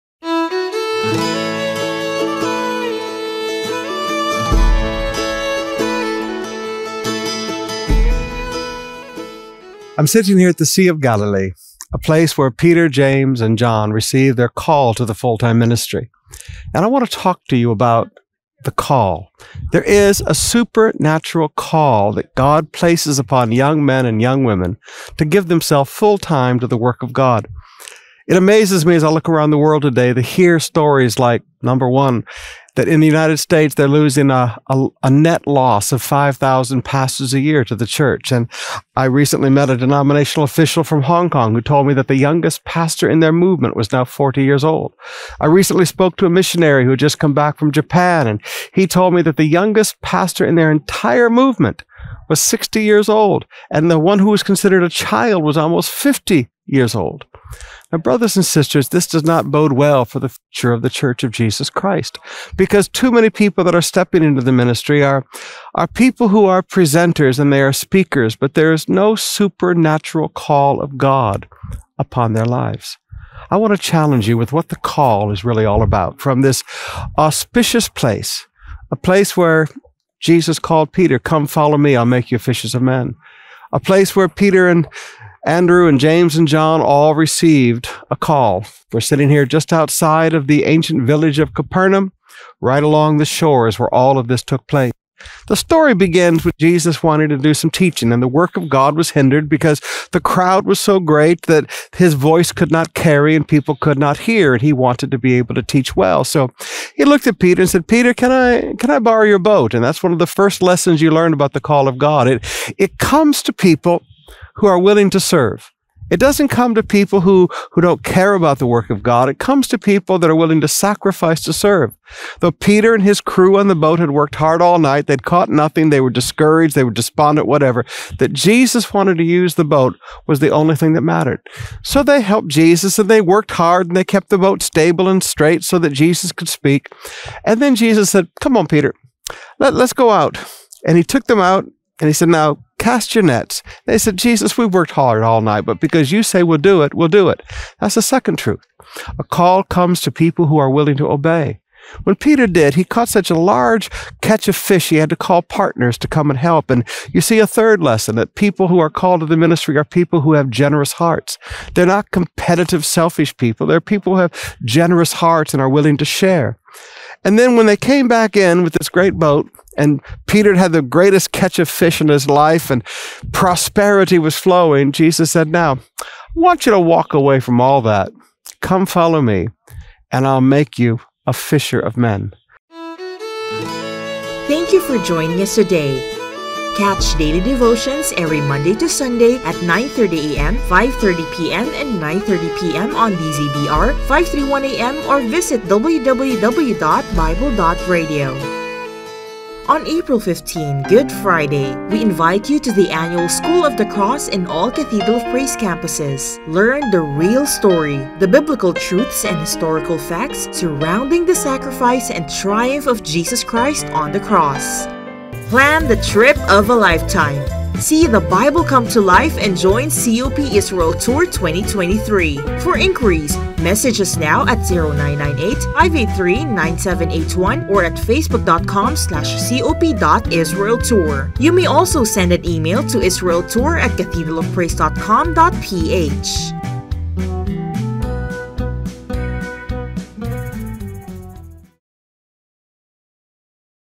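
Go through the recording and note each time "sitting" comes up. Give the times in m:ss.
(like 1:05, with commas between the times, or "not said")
0:10, 1:28.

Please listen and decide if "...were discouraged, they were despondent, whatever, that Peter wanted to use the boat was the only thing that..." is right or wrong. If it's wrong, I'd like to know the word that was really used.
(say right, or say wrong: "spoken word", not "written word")
wrong: "Jesus", not "Peter".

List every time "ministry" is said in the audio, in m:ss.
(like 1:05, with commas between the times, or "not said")
0:15, 1:04, 2:39.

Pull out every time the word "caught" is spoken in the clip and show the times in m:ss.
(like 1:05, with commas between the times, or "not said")
2:05, 2:32.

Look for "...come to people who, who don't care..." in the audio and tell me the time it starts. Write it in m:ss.
1:56.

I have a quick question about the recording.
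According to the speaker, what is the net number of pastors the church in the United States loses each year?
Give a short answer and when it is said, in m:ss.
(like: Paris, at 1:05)
5,000, at 0:36.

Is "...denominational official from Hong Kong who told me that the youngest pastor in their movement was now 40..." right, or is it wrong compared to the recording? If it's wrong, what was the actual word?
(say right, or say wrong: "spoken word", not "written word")
right.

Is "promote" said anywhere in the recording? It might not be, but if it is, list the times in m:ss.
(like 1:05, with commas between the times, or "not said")
not said.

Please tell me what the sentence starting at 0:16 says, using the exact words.
And I want to talk to you about the call.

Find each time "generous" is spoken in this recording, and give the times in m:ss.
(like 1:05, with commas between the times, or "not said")
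2:40, 2:44.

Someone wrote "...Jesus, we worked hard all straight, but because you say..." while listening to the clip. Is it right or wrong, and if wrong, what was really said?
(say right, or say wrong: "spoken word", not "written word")
wrong: "night", not "straight".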